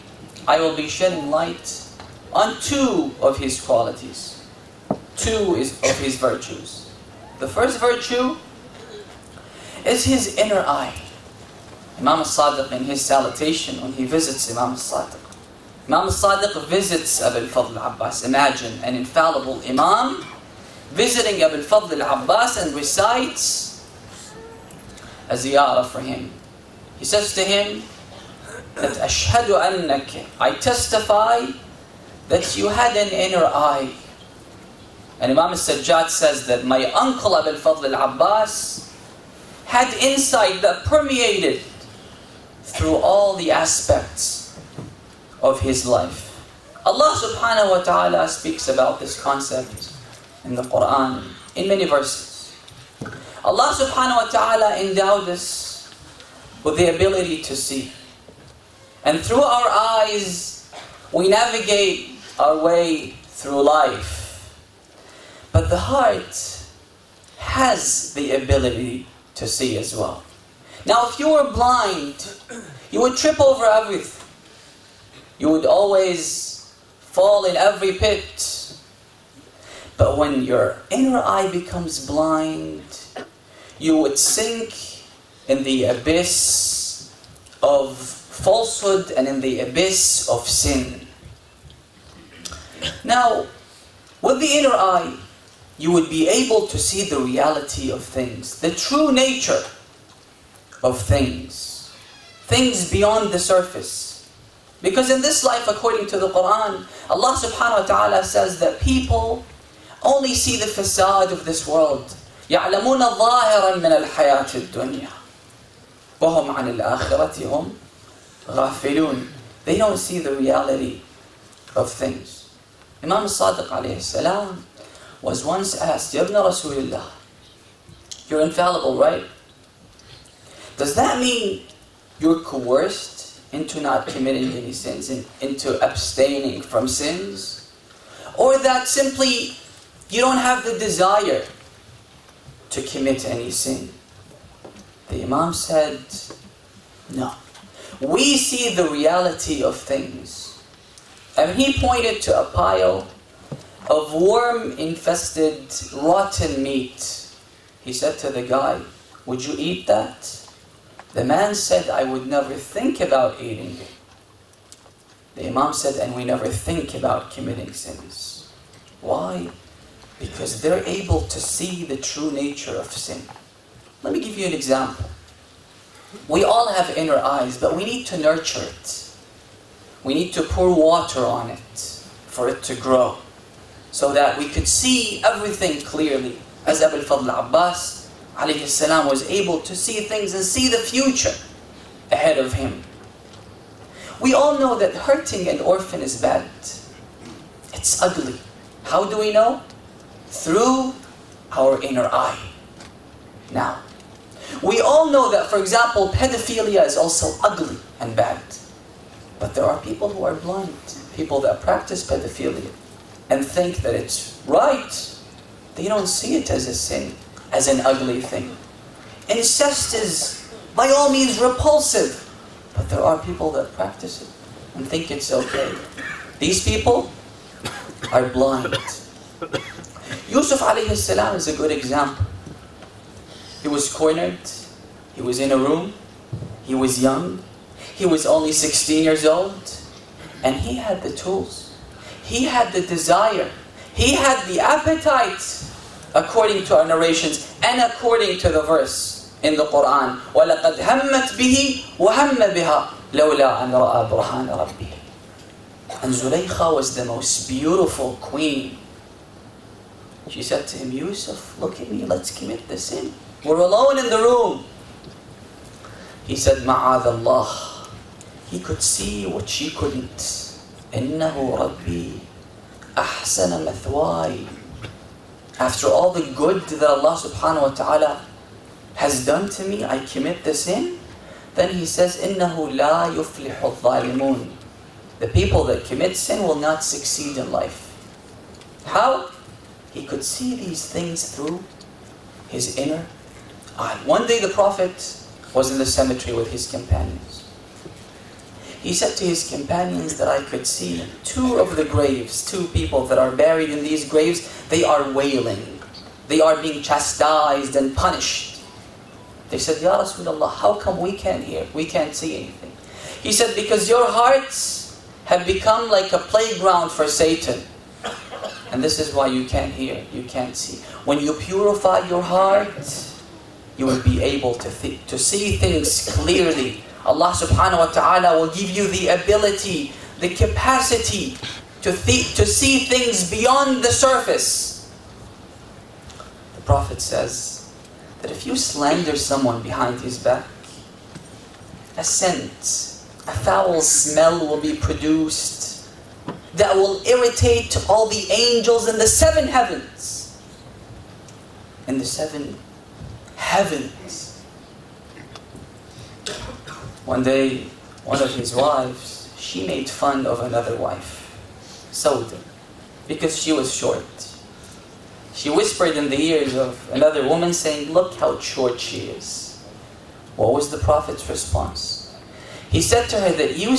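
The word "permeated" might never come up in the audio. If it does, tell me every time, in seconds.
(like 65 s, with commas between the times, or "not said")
40 s.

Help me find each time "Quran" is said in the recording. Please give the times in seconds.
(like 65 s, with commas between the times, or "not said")
50 s, 106 s, 249 s.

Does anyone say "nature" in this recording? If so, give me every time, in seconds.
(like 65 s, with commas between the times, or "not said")
99 s, 172 s.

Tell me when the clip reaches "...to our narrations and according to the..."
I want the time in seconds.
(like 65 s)
246 s.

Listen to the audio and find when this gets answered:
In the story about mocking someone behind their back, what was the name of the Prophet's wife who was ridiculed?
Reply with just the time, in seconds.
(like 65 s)
361 s.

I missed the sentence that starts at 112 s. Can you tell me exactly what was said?
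يعلمون ظاهرا من الحياة الدنيا وهم عن الآخرة هم غافلون They don't see the reality of things.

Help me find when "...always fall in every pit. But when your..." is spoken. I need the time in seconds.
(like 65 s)
75 s.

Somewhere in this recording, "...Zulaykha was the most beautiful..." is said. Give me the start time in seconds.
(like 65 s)
256 s.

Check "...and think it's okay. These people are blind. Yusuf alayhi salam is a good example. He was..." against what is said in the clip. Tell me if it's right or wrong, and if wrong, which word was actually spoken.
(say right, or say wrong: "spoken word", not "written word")
right.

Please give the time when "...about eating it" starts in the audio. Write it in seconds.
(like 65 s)
162 s.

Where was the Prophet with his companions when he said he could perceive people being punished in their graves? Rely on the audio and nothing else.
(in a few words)
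The cemetery.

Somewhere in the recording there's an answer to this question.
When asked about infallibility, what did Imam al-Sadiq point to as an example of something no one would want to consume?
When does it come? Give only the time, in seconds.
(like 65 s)
154 s.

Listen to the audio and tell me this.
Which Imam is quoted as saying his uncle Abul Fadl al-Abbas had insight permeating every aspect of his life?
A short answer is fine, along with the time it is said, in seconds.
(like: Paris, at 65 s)
Imam al-Sajjad, at 35 s.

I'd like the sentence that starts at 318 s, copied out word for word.
And this is why you can't hear, you can't see.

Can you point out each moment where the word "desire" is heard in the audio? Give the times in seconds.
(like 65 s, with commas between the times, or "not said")
140 s, 242 s.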